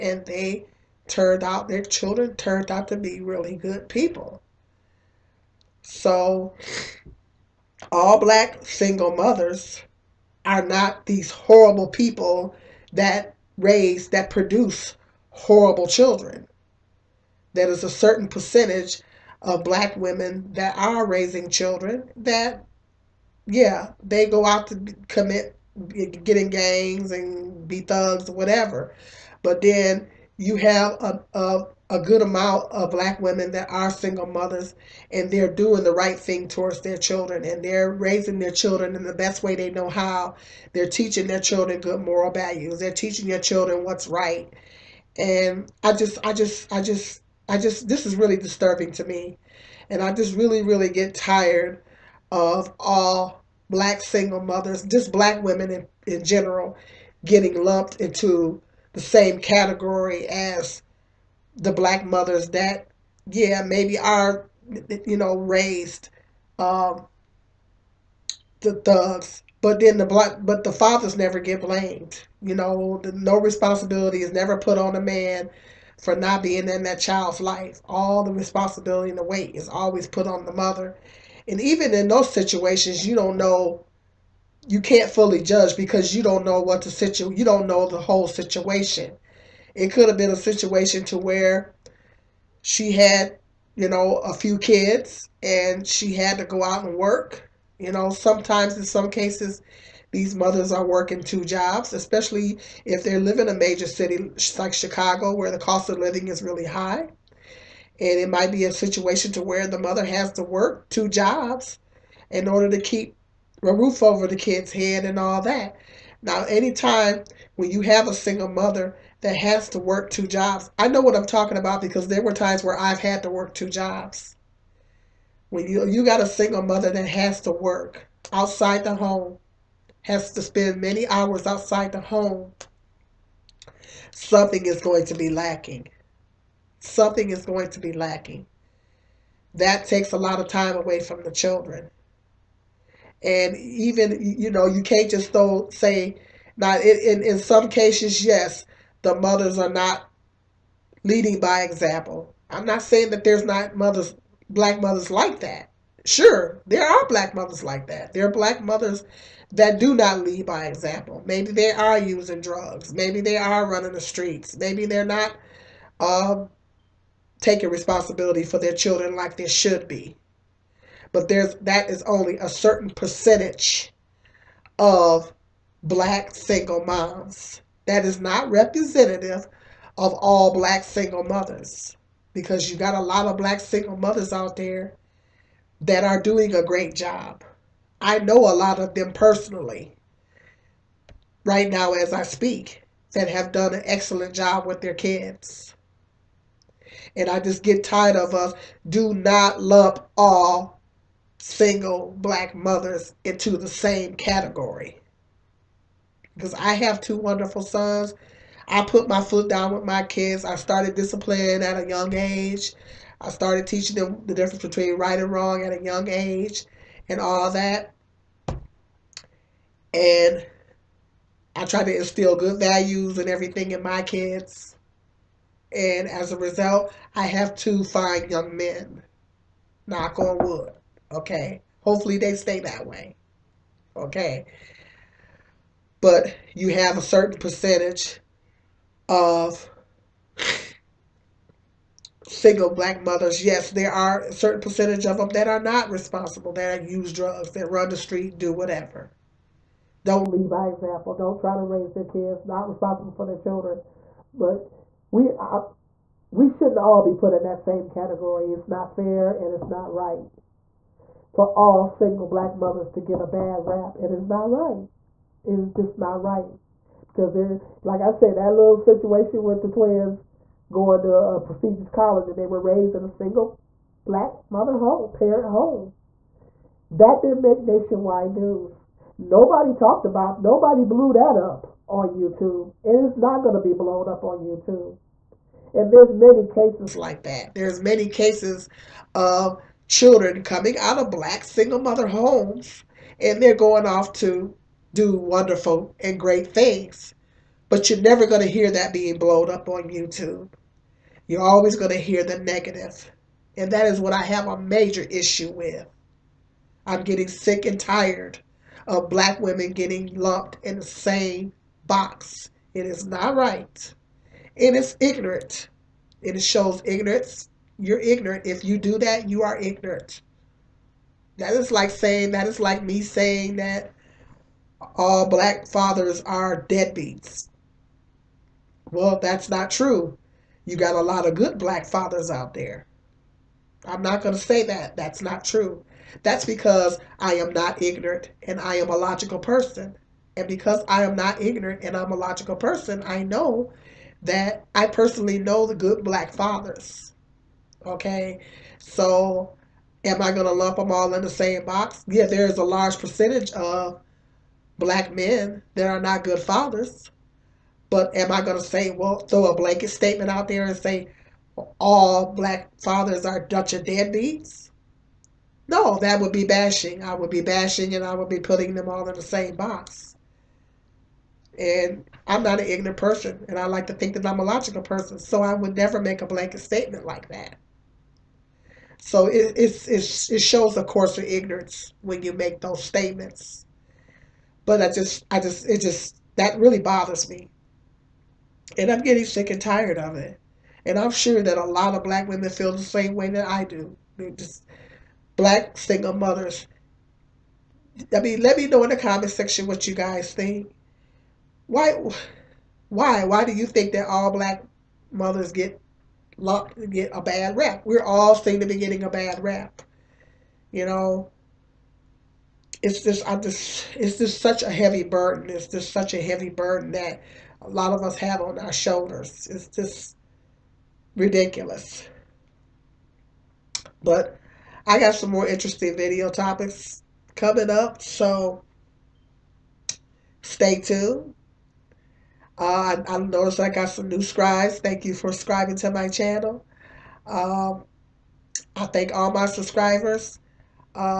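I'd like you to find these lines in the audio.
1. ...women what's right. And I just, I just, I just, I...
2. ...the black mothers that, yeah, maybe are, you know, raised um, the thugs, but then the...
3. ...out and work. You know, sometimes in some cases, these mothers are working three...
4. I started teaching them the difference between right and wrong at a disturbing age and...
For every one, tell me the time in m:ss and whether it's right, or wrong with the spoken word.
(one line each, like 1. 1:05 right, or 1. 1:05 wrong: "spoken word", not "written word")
1. 0:43 wrong: "children", not "women"
2. 1:01 right
3. 1:36 wrong: "two", not "three"
4. 3:33 wrong: "young", not "disturbing".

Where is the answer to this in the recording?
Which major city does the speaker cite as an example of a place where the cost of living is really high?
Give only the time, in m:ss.
1:44.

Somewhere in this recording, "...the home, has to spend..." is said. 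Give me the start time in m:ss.
2:08.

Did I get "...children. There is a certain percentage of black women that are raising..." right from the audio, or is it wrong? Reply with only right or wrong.
right.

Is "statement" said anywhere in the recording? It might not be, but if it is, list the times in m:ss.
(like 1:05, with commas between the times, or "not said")
5:59, 6:16, 6:22.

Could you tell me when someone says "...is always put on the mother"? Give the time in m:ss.
1:19.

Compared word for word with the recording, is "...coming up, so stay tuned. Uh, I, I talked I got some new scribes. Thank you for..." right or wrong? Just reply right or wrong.
wrong.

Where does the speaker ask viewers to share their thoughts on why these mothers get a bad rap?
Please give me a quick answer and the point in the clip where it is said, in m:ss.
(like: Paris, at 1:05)
Comment section, at 6:38.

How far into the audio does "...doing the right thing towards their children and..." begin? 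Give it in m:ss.
0:35.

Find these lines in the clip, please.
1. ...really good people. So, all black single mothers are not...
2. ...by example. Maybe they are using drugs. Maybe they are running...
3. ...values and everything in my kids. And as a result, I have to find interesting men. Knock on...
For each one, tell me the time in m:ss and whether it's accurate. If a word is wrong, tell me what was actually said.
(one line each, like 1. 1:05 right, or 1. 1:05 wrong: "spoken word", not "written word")
1. 0:03 right
2. 2:40 right
3. 3:42 wrong: "young", not "interesting".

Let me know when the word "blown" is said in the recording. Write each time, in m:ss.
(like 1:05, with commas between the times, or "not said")
4:43, 4:59.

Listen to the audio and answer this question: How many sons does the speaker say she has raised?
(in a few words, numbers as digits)
2.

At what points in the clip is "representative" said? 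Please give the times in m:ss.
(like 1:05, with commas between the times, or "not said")
2:58.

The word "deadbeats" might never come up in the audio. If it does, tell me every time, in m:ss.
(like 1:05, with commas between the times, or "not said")
5:26, 6:03.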